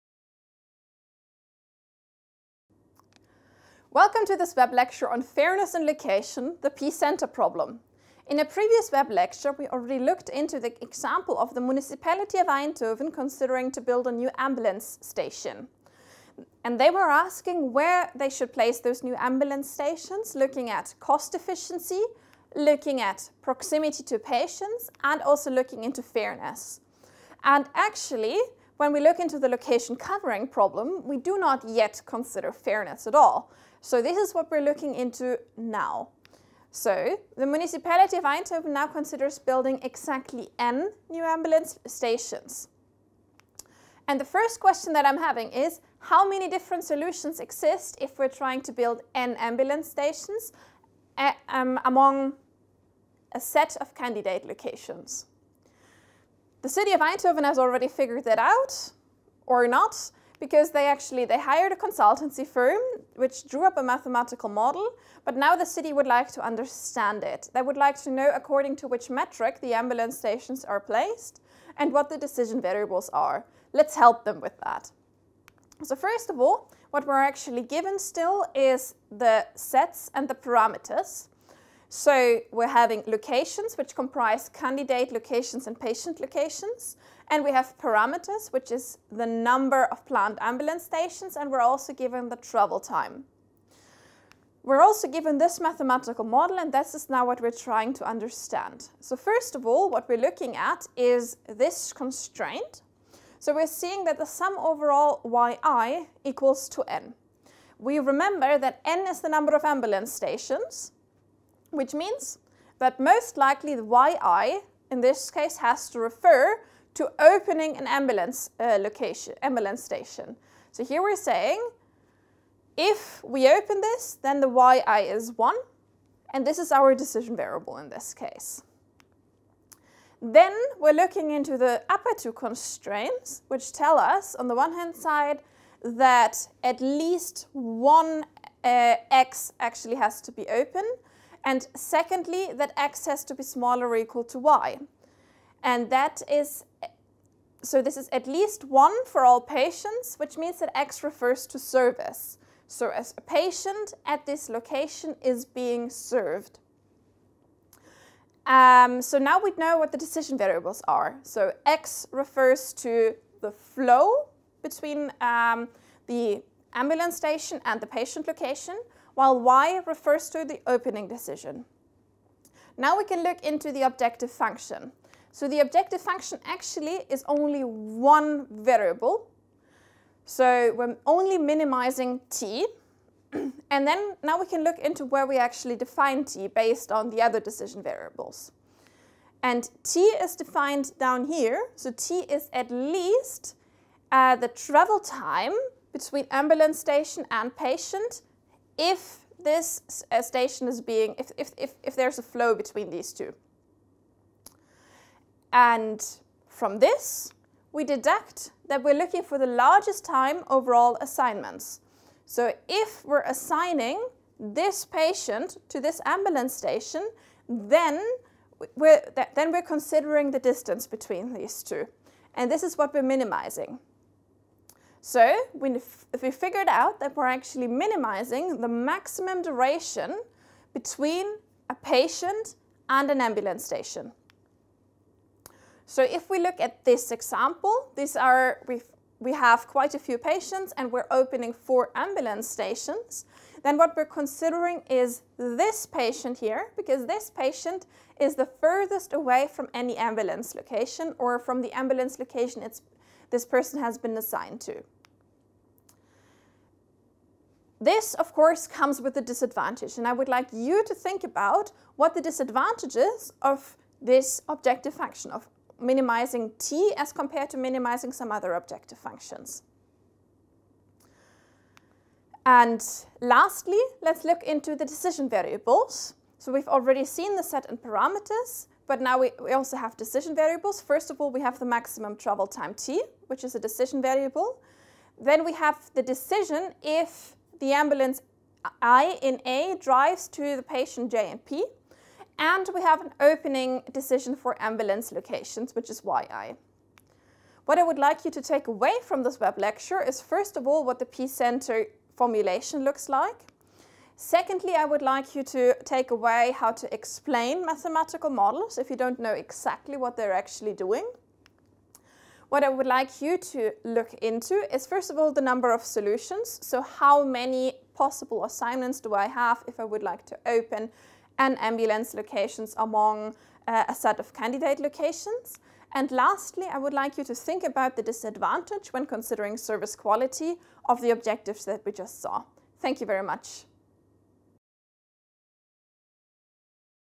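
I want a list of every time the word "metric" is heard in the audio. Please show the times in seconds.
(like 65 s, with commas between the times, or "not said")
69 s.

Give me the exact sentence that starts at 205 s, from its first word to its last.
And from this, we deduct that we're looking for the largest time overall assignments.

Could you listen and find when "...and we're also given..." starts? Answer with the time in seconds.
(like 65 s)
91 s.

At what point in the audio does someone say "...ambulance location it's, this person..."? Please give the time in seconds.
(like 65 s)
251 s.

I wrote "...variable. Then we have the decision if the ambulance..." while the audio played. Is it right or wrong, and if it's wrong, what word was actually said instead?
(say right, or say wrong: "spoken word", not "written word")
right.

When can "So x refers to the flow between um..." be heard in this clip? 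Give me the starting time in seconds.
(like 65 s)
161 s.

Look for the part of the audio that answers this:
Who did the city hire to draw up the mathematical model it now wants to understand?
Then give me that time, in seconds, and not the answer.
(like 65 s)
61 s.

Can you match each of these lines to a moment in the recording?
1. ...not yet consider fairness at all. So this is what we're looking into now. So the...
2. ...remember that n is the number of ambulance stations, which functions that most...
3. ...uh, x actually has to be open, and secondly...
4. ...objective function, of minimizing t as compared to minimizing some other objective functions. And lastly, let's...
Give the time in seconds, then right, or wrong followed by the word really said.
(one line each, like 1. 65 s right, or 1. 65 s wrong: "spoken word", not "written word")
1. 31 s right
2. 107 s wrong: "means", not "functions"
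3. 138 s right
4. 264 s right.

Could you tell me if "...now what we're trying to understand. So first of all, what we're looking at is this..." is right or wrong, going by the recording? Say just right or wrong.
right.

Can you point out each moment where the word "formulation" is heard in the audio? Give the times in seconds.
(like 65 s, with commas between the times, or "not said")
302 s.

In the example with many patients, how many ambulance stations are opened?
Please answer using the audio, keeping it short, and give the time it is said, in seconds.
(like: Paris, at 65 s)
4, at 241 s.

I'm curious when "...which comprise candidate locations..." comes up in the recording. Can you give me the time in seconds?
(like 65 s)
83 s.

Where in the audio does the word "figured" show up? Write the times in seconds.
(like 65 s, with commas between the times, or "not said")
57 s, 226 s.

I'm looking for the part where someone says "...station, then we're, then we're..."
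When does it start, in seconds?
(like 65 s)
216 s.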